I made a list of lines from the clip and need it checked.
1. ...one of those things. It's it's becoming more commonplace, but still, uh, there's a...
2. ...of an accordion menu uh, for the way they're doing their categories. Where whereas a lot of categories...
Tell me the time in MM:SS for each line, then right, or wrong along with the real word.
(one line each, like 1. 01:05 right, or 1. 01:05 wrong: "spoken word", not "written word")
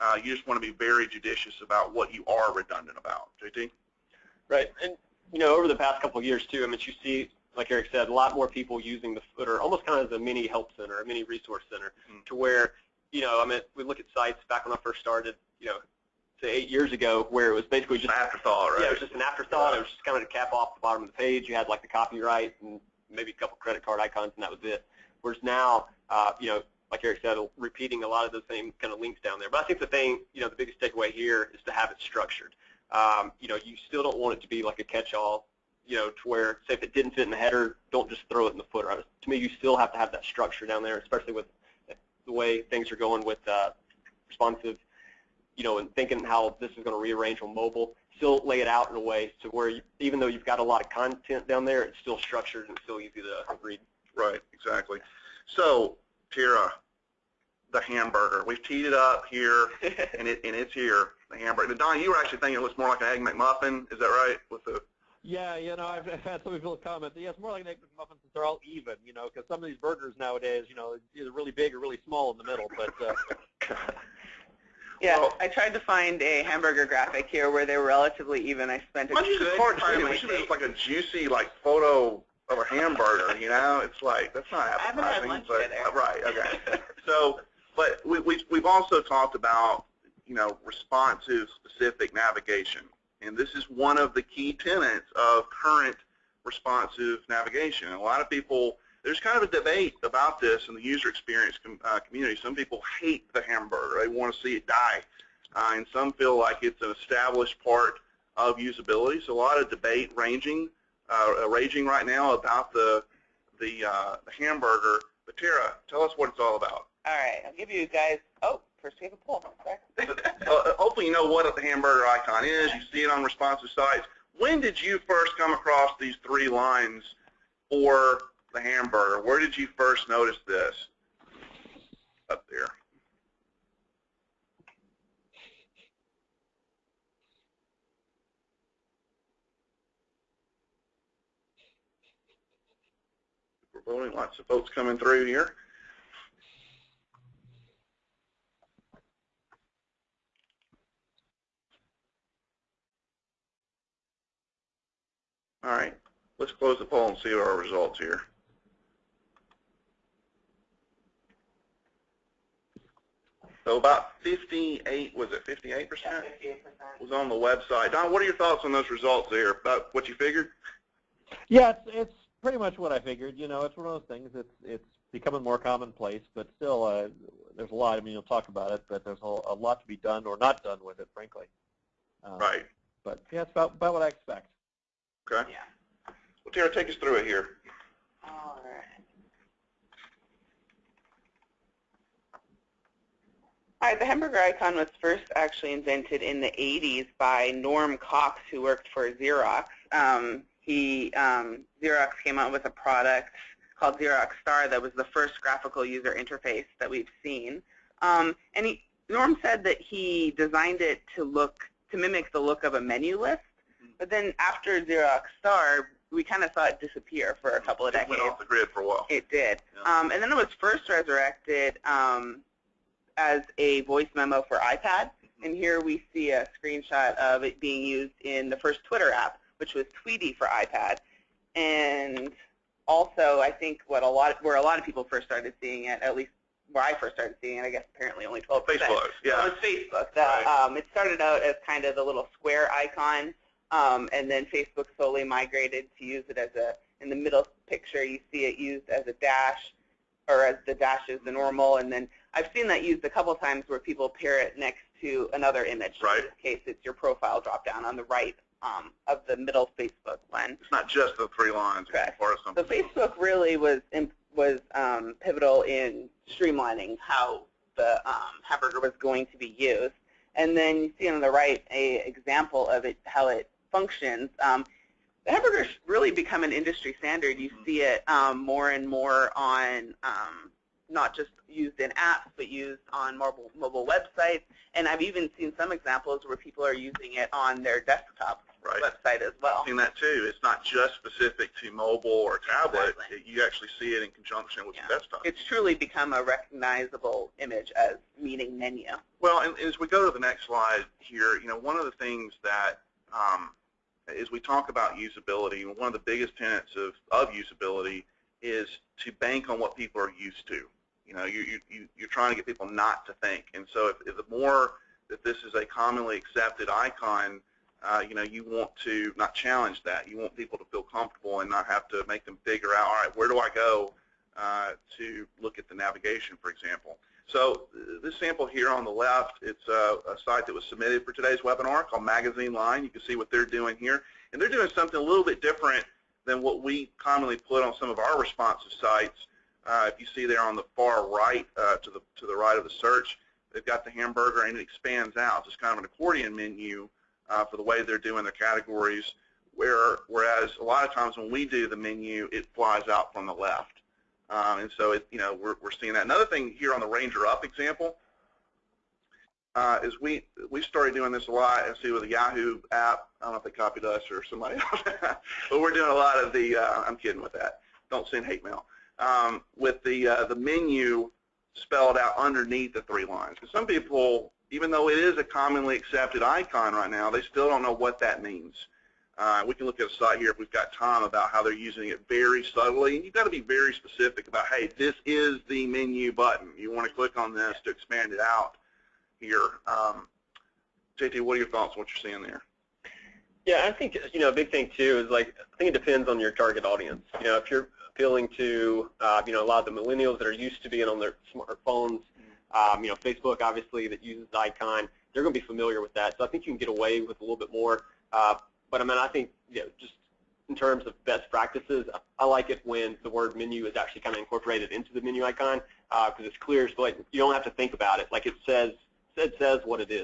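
1. 02:53 right
2. 05:45 wrong: "times", not "categories".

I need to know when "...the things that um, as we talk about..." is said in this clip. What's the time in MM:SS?
05:01.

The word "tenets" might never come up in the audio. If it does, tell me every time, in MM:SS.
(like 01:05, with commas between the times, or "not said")
01:34, 05:06.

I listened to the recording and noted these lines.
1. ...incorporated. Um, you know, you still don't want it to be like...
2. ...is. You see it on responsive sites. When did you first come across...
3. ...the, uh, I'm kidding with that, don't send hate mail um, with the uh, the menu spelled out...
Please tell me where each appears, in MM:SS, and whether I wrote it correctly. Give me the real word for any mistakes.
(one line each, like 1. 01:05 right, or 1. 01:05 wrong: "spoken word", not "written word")
1. 00:32 wrong: "structured", not "incorporated"
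2. 02:02 right
3. 06:06 right.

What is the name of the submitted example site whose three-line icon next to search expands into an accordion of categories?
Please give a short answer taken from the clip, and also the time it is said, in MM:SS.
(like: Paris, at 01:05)
Magazine Line, at 05:32.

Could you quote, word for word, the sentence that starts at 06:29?
Um, JT, what are your thoughts on what you're seeing there?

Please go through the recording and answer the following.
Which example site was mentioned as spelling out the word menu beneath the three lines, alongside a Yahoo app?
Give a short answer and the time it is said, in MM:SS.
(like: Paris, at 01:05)
Ranger Up, at 05:56.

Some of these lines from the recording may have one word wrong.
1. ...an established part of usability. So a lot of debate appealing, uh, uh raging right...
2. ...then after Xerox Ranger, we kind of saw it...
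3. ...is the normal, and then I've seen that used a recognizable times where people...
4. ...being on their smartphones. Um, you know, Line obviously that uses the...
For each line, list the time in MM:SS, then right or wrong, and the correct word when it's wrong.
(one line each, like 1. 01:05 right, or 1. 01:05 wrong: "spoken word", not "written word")
1. 01:46 wrong: "ranging", not "appealing"
2. 03:34 wrong: "Star", not "Ranger"
3. 04:11 wrong: "couple", not "recognizable"
4. 06:40 wrong: "Facebook", not "Line".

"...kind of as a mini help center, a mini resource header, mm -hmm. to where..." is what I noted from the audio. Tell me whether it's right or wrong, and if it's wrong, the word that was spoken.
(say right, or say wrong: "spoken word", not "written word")
wrong: "center", not "header".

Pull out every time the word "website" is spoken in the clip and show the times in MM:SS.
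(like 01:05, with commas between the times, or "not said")
02:47, 04:43, 04:48.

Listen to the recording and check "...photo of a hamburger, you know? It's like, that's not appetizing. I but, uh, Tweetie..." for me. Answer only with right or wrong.
wrong.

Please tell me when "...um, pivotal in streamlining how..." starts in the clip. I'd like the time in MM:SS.
04:24.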